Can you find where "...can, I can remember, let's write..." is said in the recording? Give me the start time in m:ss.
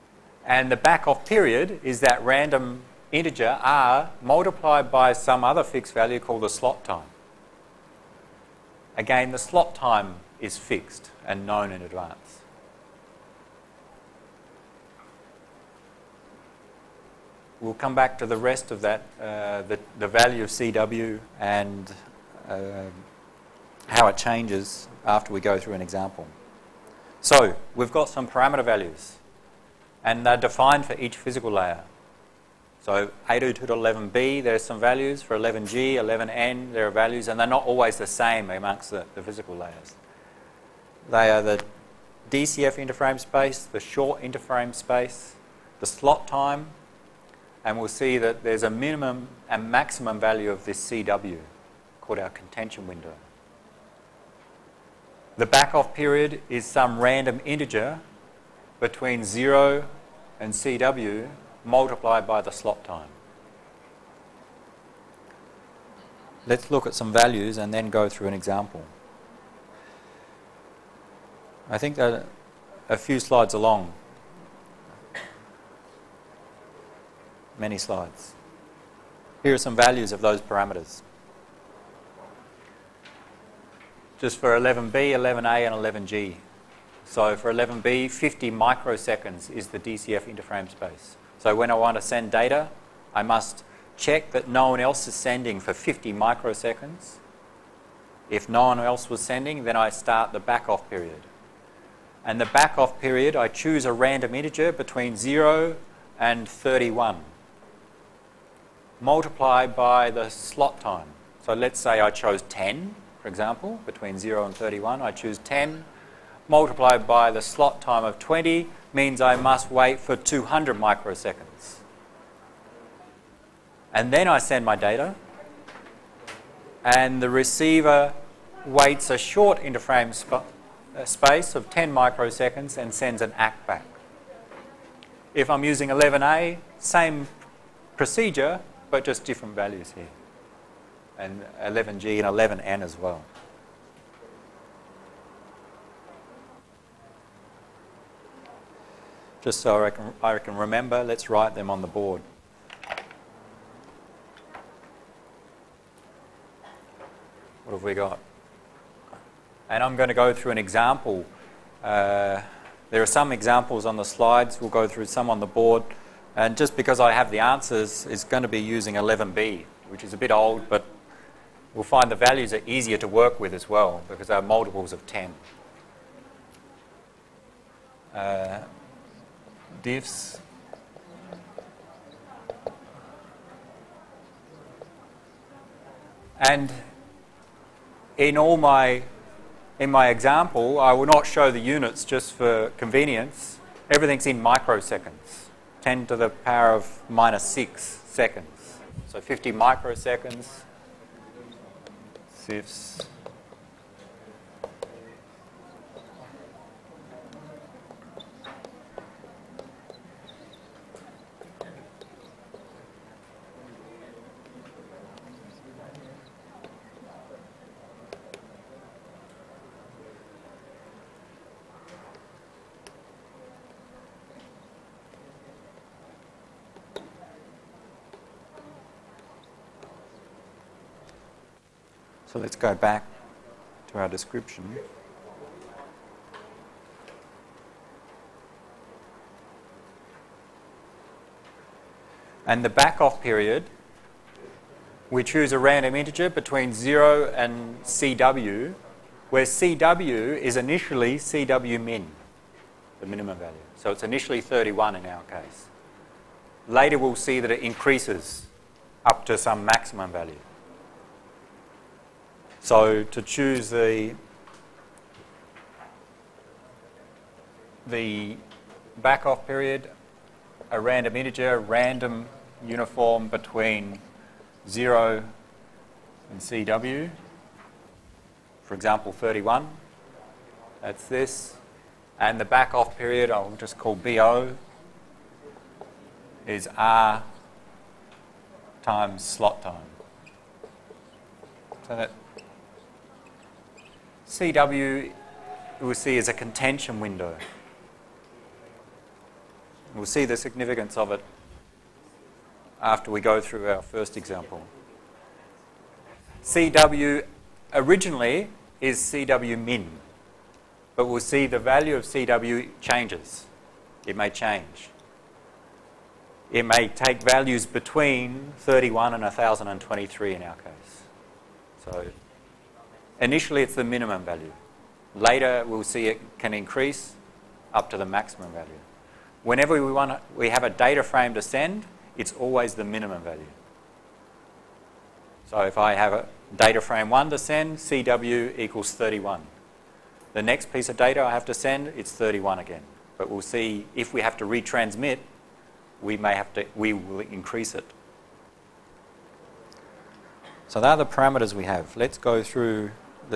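2:29.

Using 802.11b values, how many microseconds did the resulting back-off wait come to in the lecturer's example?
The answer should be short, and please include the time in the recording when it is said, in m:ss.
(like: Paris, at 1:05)
200 microseconds, at 2:00.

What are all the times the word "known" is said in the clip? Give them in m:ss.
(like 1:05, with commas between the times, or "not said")
0:11.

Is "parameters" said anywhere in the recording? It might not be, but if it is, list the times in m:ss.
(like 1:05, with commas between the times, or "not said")
0:28, 1:20, 5:51.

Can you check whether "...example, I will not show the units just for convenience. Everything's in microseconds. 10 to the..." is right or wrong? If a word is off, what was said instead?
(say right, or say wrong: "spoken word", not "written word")
right.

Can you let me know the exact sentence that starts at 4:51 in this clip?
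So that CW we'll see is a contention window.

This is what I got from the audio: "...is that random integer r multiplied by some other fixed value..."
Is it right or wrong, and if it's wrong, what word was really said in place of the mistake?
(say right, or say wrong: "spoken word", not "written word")
right.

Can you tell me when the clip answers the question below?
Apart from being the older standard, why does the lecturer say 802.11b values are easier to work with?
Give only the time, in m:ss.
2:54.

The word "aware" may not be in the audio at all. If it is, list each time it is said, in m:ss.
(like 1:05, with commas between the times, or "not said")
not said.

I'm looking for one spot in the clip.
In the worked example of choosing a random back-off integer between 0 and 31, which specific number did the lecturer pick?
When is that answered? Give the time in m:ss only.
1:55.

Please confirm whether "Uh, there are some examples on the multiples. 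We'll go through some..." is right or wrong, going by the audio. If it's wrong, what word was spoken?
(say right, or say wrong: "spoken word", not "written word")
wrong: "slides", not "multiples".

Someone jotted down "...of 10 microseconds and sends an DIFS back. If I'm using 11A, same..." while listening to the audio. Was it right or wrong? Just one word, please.
wrong.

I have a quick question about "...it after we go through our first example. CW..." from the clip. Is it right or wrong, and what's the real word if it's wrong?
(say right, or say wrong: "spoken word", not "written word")
right.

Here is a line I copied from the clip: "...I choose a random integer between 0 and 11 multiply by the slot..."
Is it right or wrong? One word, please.
wrong.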